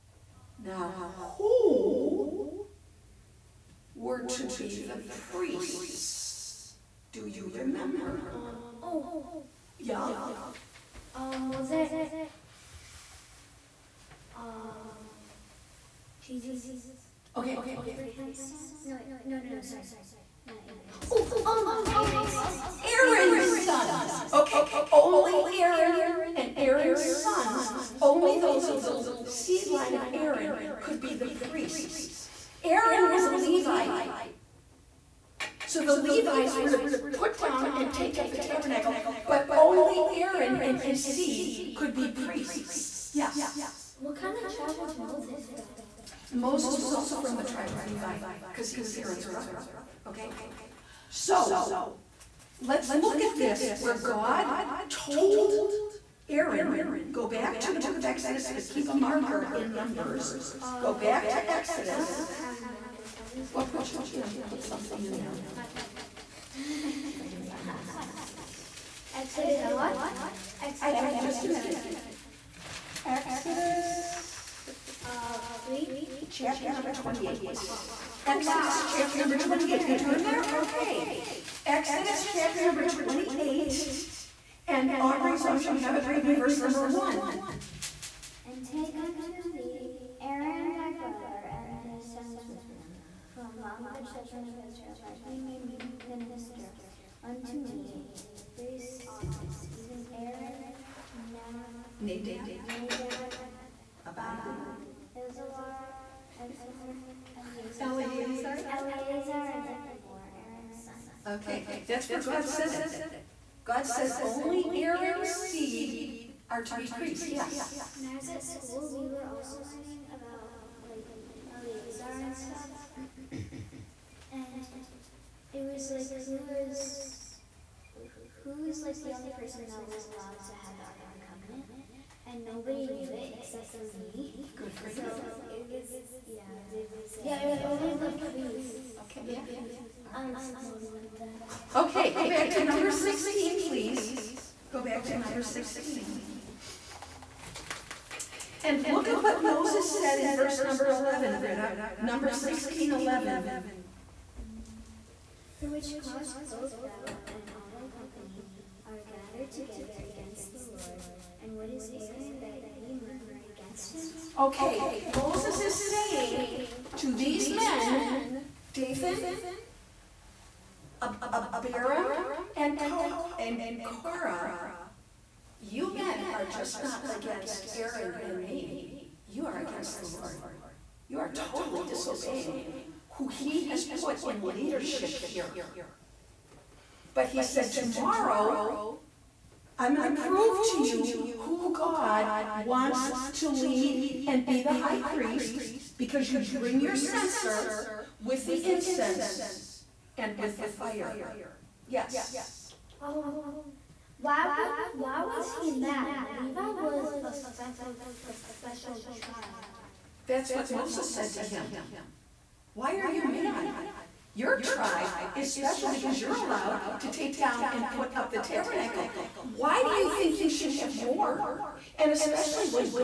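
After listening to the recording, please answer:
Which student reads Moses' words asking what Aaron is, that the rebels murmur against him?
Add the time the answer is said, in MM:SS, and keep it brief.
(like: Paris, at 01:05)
Britta, at 02:31.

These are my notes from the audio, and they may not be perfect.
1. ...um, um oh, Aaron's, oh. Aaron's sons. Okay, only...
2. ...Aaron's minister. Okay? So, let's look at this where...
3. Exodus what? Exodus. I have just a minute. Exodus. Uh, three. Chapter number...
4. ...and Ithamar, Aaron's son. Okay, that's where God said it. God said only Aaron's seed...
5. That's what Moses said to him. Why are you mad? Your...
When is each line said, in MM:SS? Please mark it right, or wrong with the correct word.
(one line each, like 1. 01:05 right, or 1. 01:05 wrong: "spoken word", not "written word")
1. 00:21 right
2. 00:48 wrong: "brother", not "minister"
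3. 01:09 right
4. 01:49 right
5. 03:30 right.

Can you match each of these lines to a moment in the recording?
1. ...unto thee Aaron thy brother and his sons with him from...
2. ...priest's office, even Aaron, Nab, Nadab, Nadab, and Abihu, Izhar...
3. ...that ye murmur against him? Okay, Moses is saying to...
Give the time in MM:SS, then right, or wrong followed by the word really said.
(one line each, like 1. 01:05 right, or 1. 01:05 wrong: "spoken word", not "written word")
1. 01:28 right
2. 01:38 right
3. 02:42 right.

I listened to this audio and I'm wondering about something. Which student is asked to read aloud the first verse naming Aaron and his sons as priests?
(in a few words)
Aubrey.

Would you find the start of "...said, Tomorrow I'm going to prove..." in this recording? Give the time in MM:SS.
03:07.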